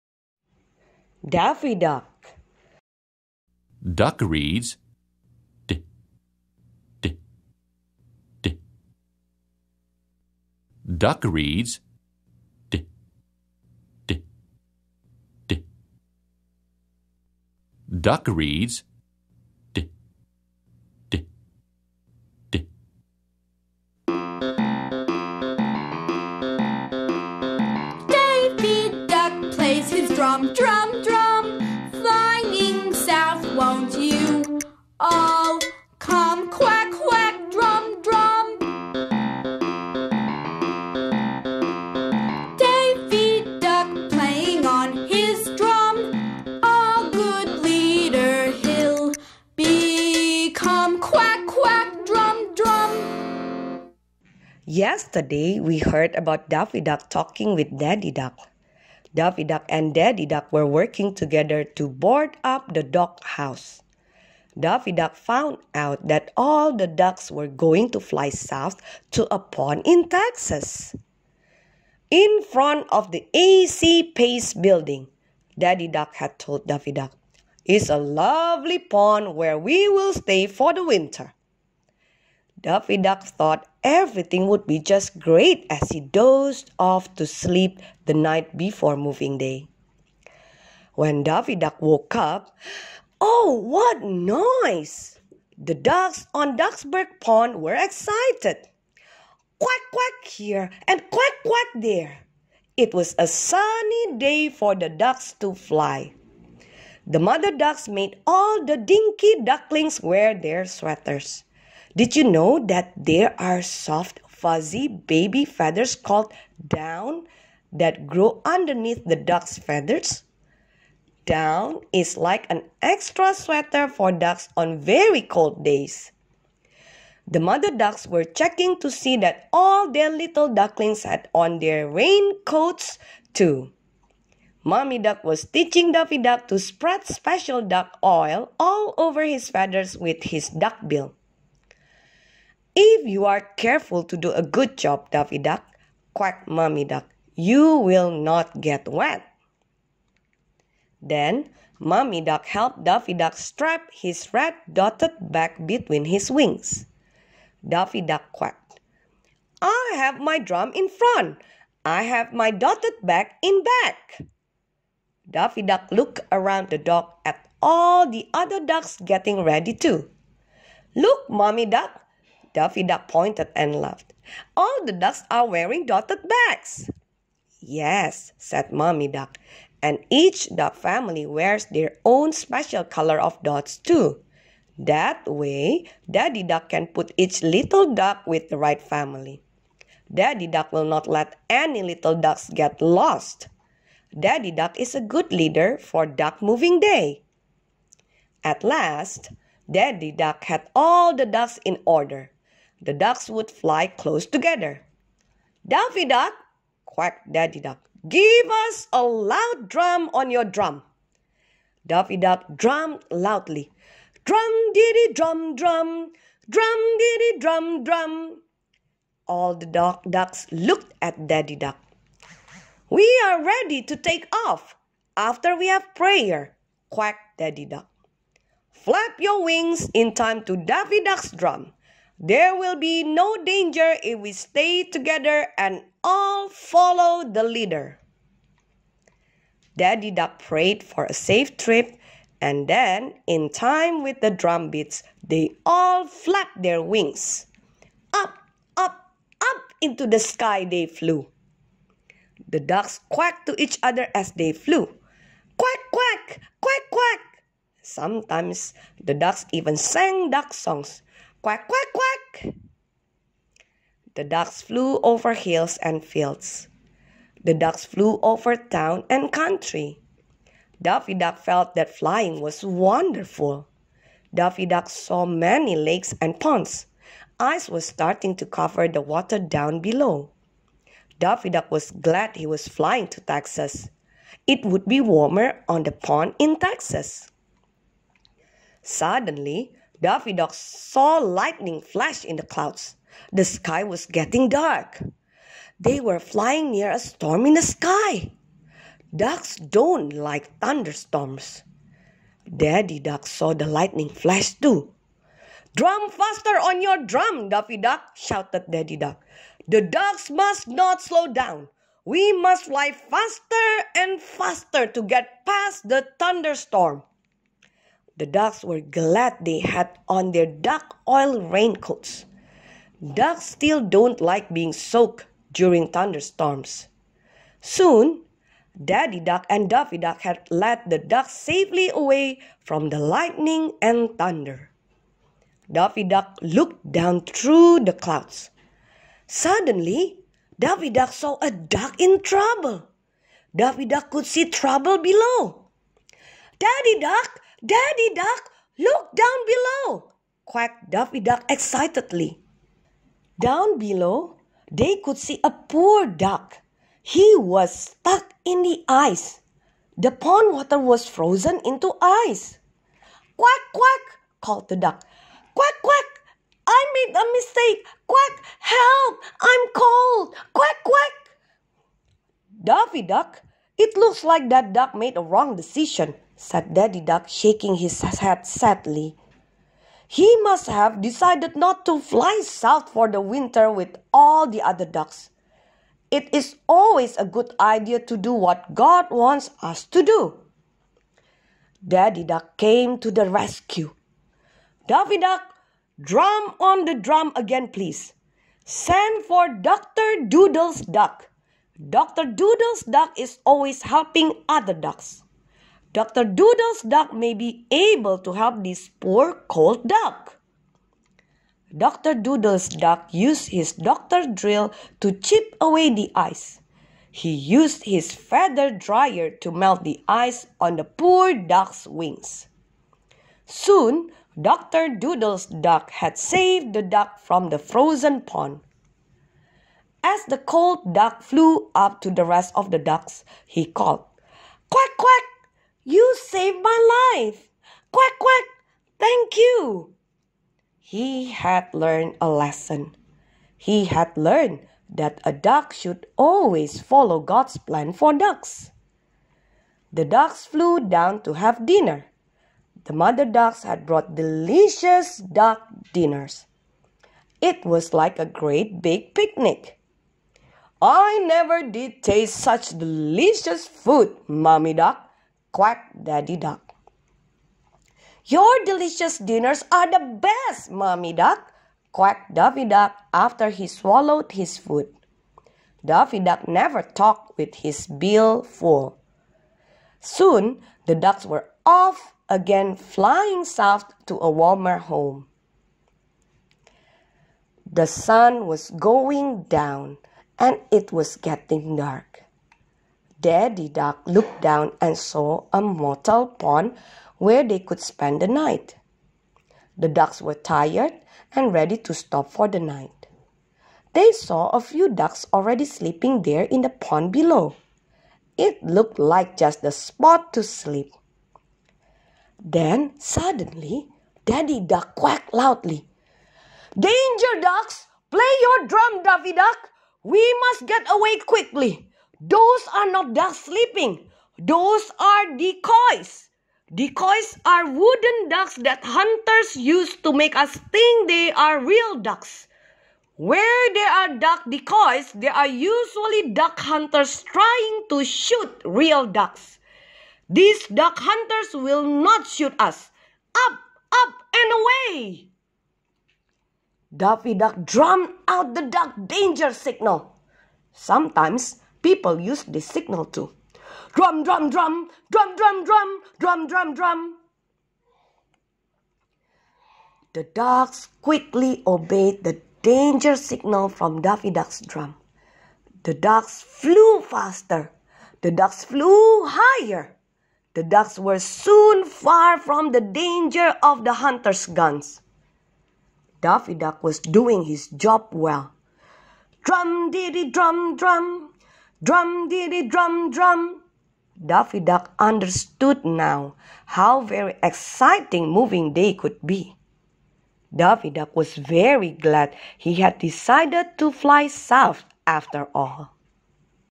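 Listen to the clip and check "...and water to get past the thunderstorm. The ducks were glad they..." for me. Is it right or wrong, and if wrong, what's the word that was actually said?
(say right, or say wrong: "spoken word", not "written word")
wrong: "faster", not "water".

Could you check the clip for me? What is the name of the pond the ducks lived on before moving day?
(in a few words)
Ducksburg Pond.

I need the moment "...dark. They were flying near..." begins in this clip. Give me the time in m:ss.
4:54.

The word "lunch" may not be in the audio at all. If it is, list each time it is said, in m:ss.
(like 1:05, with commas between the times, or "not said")
not said.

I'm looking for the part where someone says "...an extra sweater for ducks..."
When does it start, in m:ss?
2:02.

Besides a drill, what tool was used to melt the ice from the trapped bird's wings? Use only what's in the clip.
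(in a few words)
Feather dryer.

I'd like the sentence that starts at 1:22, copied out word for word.
Daffy Duck thought everything would be just great as he dozed off to sleep the night before moving day.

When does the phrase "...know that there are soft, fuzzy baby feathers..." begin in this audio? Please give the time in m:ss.
1:52.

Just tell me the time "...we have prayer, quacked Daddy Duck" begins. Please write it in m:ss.
3:45.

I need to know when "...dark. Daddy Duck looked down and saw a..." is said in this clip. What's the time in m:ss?
8:11.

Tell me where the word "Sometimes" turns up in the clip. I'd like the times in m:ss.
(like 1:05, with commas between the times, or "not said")
4:17, 9:10.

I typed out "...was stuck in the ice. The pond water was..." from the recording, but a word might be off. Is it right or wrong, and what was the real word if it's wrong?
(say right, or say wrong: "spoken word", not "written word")
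right.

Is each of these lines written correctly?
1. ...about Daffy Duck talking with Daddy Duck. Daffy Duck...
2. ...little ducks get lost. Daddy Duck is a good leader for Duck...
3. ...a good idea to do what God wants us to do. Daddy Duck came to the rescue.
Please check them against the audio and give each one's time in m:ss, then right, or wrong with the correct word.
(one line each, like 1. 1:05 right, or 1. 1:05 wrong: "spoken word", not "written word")
1. 0:56 right
2. 3:11 right
3. 6:27 right.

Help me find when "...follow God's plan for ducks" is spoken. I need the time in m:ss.
7:26.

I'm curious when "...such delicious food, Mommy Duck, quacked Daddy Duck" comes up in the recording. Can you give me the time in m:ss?
7:42.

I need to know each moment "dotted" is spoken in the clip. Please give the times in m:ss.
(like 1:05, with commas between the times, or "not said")
2:34, 2:42, 2:55.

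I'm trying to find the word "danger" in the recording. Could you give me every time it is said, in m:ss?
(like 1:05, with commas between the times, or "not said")
3:53, 8:36, 9:09, 9:22, 9:32.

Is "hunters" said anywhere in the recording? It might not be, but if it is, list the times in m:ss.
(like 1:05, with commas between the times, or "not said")
8:48, 8:56, 9:00, 9:33.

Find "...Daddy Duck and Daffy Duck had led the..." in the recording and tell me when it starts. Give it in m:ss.
5:28.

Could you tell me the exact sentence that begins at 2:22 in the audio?
If you are careful to do a good job, Daffy duck, quacked Mommy duck, you will not get wet.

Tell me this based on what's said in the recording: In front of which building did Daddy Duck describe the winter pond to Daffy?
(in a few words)
AC Pace building.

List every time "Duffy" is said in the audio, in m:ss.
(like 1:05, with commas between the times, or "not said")
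5:50, 6:12.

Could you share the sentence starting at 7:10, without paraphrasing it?
As the cold duck flew up to the rest of the ducks, he called, Quack, quack, you saved my life!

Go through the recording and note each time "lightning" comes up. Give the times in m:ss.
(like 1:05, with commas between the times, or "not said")
4:51, 5:03, 5:32.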